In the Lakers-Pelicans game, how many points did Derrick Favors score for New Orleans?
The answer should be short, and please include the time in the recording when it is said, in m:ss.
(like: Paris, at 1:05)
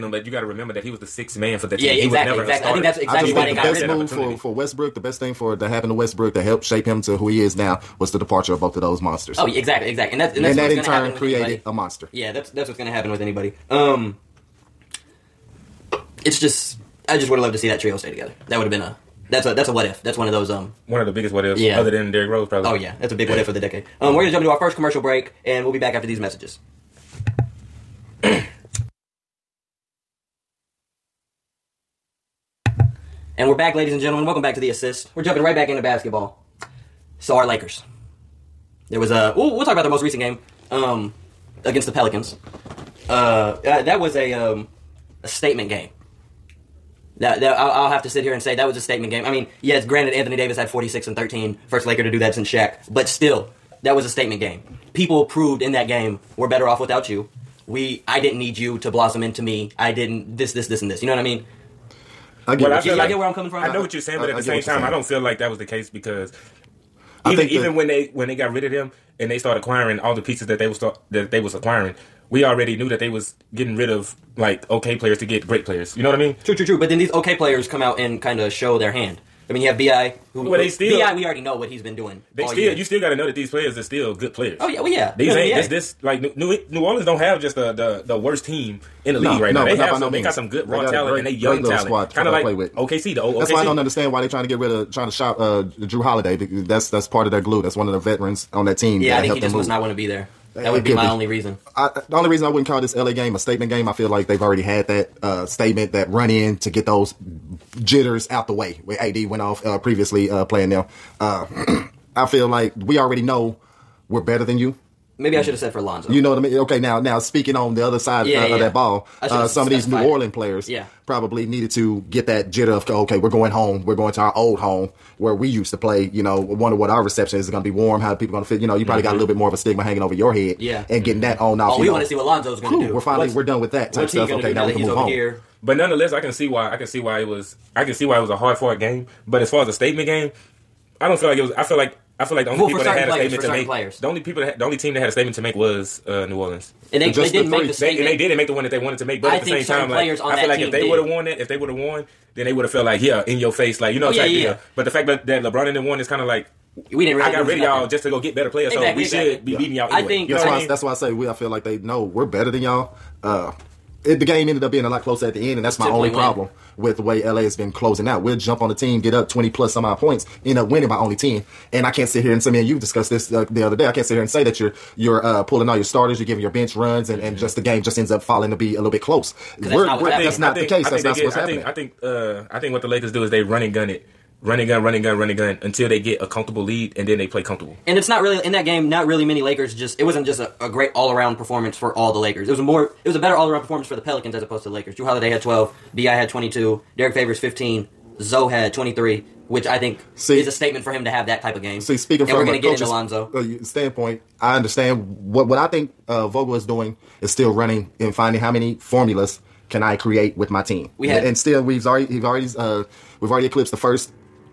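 15, at 3:17.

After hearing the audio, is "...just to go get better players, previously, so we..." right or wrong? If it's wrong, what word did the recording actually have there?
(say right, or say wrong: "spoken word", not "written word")
wrong: "exactly", not "previously".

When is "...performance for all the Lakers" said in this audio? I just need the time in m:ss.
3:11.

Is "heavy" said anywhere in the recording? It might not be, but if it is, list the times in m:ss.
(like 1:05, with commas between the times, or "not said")
not said.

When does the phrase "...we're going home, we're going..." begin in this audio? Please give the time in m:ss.
2:03.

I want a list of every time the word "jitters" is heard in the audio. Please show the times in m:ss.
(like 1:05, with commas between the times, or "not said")
1:47, 2:02.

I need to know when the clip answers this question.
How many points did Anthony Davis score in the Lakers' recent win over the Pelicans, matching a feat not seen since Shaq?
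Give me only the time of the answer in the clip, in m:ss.
0:50.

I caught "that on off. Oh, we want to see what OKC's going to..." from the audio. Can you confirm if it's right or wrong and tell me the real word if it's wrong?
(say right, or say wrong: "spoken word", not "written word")
wrong: "Lonzo", not "OKC".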